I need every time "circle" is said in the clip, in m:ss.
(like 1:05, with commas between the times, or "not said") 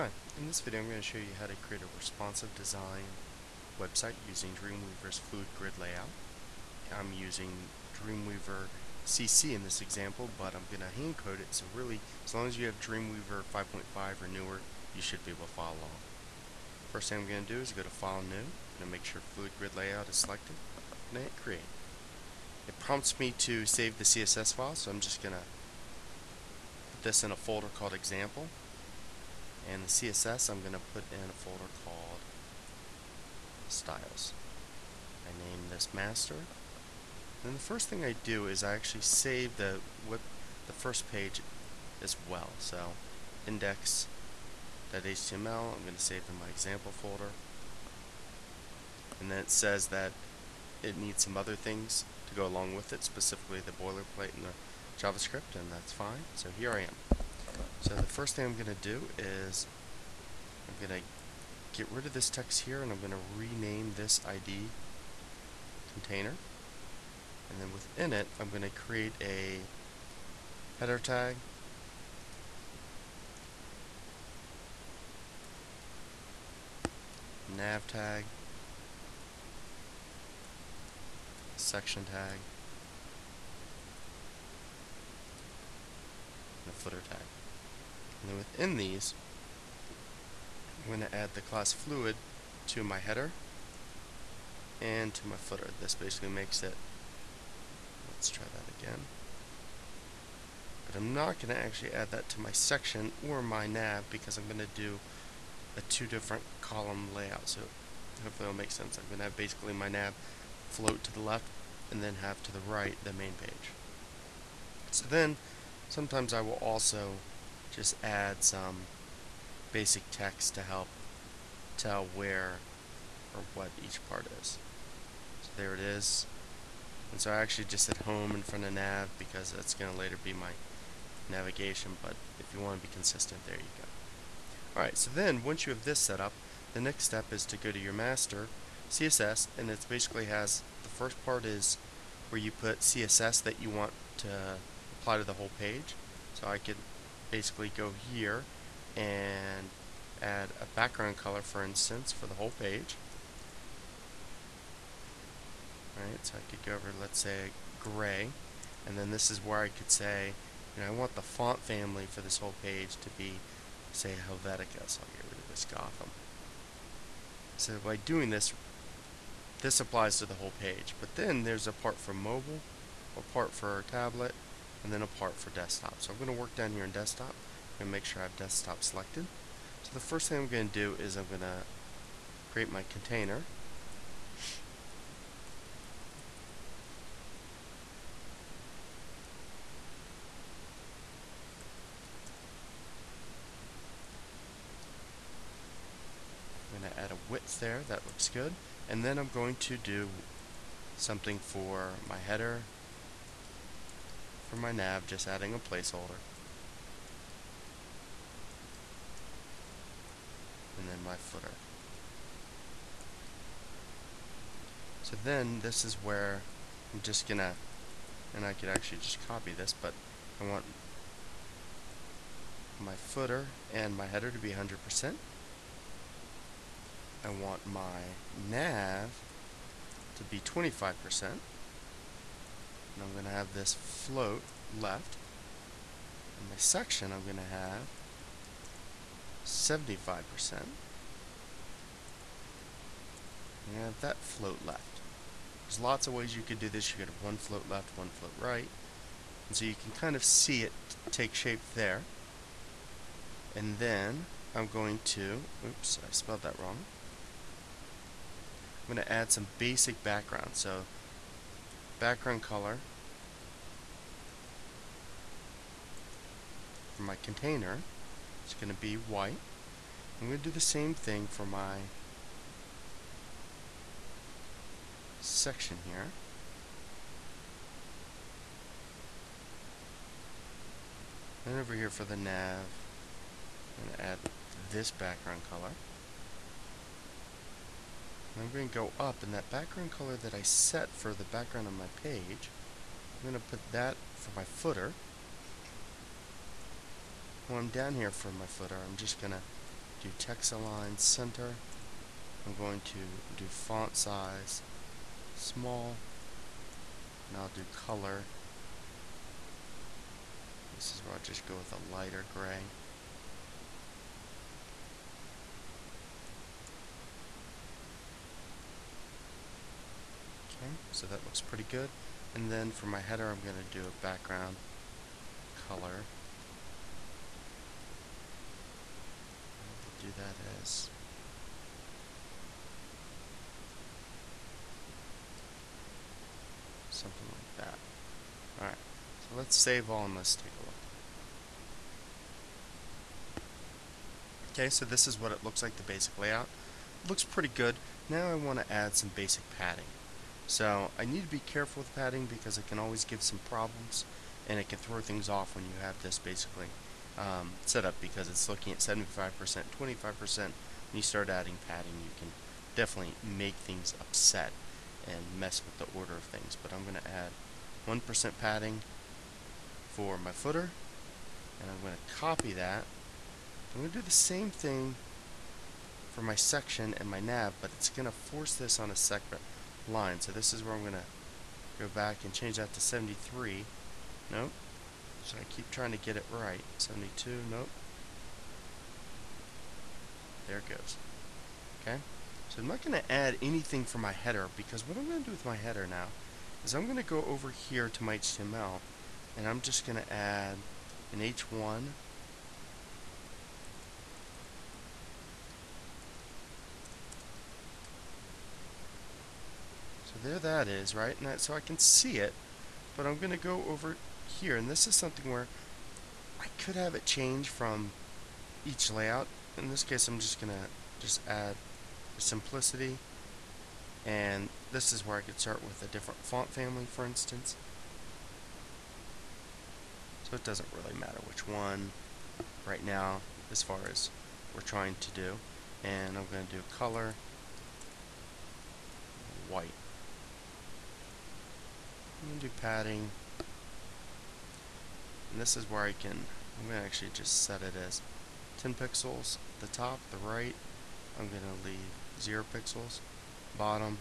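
not said.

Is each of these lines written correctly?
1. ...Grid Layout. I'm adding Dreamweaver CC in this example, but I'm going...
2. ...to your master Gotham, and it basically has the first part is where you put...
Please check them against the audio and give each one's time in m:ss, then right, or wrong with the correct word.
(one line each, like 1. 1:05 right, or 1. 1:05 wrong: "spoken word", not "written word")
1. 0:05 wrong: "using", not "adding"
2. 2:17 wrong: "CSS", not "Gotham".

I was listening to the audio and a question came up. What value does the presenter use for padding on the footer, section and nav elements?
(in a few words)
1%.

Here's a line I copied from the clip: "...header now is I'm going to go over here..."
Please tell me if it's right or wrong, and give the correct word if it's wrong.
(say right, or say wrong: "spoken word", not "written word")
right.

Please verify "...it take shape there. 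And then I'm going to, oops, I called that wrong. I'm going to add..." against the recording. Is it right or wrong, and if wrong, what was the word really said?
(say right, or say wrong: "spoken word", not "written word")
wrong: "spelled", not "called".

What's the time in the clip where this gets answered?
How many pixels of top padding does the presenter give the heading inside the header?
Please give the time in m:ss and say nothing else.
7:28.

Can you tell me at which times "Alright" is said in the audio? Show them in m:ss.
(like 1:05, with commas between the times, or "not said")
2:14.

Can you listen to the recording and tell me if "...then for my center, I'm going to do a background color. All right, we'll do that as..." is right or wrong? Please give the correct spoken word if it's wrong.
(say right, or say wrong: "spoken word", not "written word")
wrong: "header", not "center".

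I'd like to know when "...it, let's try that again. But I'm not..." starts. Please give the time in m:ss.
1:36.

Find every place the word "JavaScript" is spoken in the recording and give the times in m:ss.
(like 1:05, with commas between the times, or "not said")
0:54.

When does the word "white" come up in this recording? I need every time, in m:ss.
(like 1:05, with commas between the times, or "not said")
4:28, 7:19.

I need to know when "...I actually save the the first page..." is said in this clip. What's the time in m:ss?
0:38.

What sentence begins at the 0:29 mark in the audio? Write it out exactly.
And the CSS I'm going to put in a folder called styles.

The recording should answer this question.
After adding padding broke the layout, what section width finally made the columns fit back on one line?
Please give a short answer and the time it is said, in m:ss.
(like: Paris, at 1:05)
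72, at 6:26.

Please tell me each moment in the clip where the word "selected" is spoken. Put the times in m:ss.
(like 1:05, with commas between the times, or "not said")
0:20, 2:58.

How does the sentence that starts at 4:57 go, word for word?
When I'm down here for my footer, I'm just going to do text align center.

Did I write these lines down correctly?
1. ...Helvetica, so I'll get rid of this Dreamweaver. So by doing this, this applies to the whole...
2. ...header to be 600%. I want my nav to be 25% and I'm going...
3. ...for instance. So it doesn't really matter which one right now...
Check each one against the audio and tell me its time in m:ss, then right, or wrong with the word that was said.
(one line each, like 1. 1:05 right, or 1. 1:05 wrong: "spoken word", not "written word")
1. 2:44 wrong: "Gotham", not "Dreamweaver"
2. 3:44 wrong: "100", not "600"
3. 7:06 right.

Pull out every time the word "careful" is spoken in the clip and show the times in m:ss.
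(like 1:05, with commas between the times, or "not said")
5:51.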